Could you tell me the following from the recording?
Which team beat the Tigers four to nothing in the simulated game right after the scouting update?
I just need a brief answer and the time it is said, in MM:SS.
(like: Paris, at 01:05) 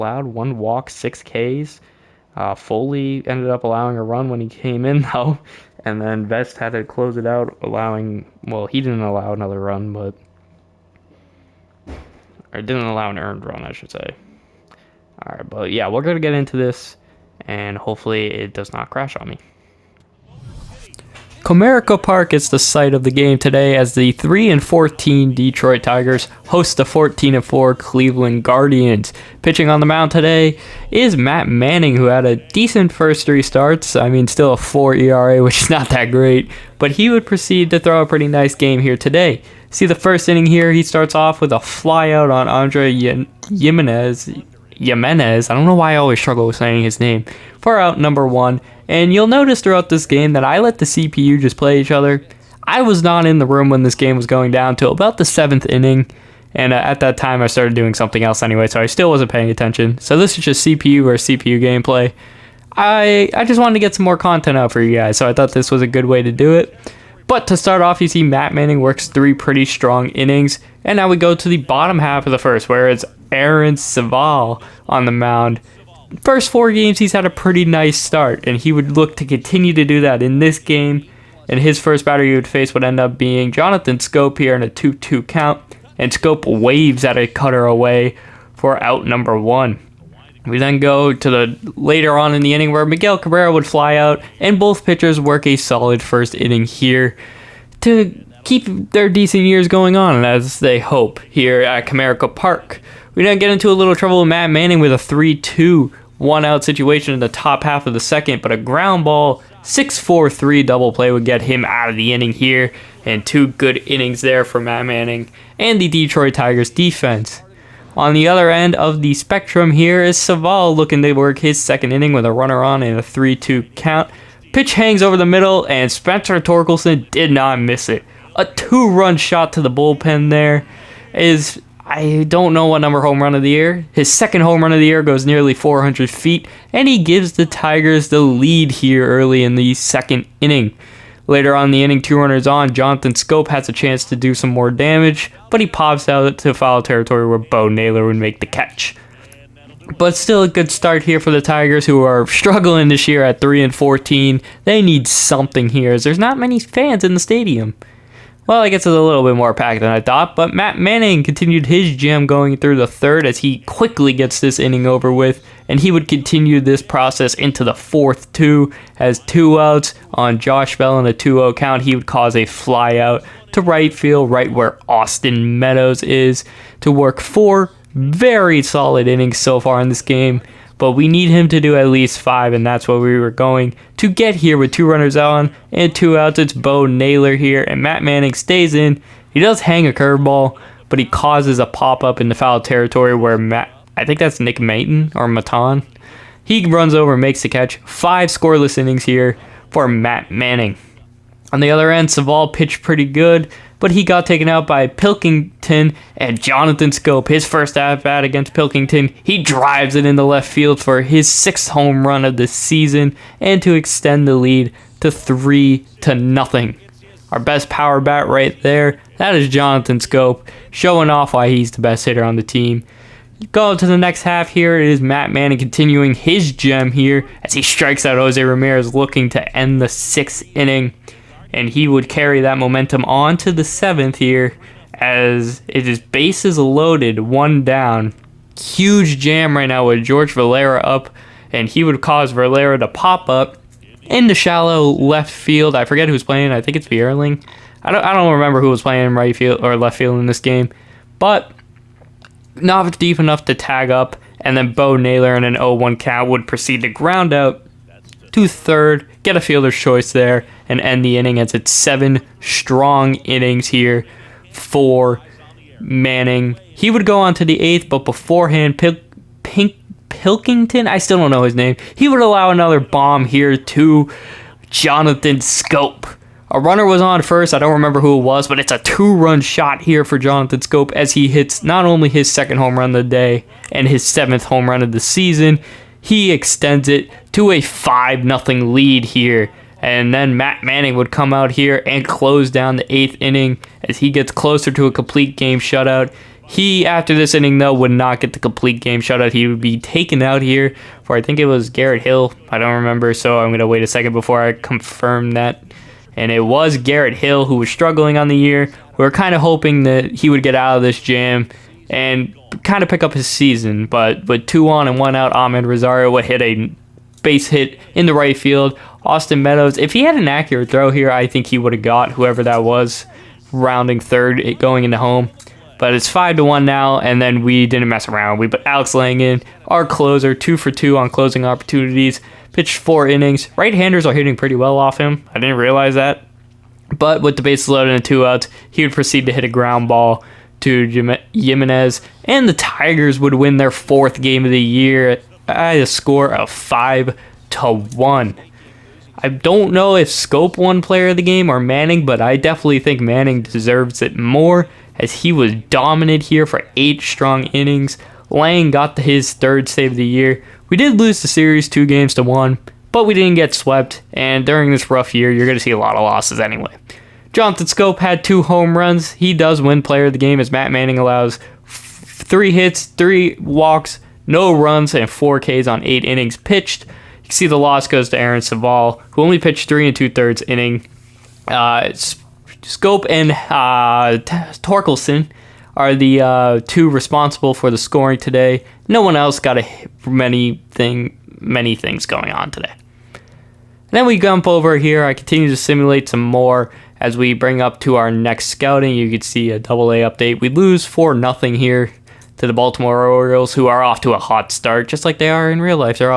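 Baltimore Orioles, at 06:42.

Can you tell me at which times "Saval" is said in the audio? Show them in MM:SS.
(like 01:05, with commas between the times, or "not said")
02:00, 03:22.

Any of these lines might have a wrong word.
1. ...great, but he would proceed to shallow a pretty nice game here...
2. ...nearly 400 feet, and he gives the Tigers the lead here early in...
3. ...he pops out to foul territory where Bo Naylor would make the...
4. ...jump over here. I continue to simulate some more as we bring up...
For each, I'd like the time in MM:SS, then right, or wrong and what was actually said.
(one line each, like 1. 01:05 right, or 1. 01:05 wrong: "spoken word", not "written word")
1. 00:36 wrong: "throw", not "shallow"
2. 02:15 right
3. 02:25 right
4. 06:34 right.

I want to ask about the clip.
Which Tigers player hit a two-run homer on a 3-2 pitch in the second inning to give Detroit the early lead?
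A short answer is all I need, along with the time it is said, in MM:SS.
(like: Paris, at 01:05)
Spencer Torkelson, at 02:05.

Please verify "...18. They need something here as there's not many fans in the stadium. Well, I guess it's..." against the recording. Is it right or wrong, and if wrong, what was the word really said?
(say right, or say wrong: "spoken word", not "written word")
wrong: "14", not "18".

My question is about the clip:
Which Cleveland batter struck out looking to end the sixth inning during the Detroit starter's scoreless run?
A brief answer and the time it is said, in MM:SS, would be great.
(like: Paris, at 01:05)
Jose Ramirez, at 03:48.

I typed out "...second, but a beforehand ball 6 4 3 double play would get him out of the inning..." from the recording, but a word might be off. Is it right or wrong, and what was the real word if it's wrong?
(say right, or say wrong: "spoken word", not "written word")
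wrong: "ground", not "beforehand".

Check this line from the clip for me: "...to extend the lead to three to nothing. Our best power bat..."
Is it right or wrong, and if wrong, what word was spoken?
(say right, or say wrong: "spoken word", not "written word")
right.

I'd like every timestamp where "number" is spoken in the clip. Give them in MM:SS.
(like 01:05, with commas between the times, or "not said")
00:47, 01:29, 02:12.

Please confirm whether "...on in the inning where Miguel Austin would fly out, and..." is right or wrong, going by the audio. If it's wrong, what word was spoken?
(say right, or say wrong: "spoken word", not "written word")
wrong: "Cabrera", not "Austin".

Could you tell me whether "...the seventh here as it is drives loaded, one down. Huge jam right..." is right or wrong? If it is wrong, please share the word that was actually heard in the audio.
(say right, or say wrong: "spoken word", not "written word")
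wrong: "bases", not "drives".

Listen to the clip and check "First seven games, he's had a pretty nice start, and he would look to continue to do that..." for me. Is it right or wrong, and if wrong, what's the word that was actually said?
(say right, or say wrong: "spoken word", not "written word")
wrong: "four", not "seven".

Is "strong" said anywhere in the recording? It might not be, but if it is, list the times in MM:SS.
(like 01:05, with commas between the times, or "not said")
01:09, 04:22, 05:57.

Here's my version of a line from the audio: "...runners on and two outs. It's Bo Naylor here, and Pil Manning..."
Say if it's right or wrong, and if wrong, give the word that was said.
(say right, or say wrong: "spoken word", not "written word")
wrong: "Matt", not "Pil".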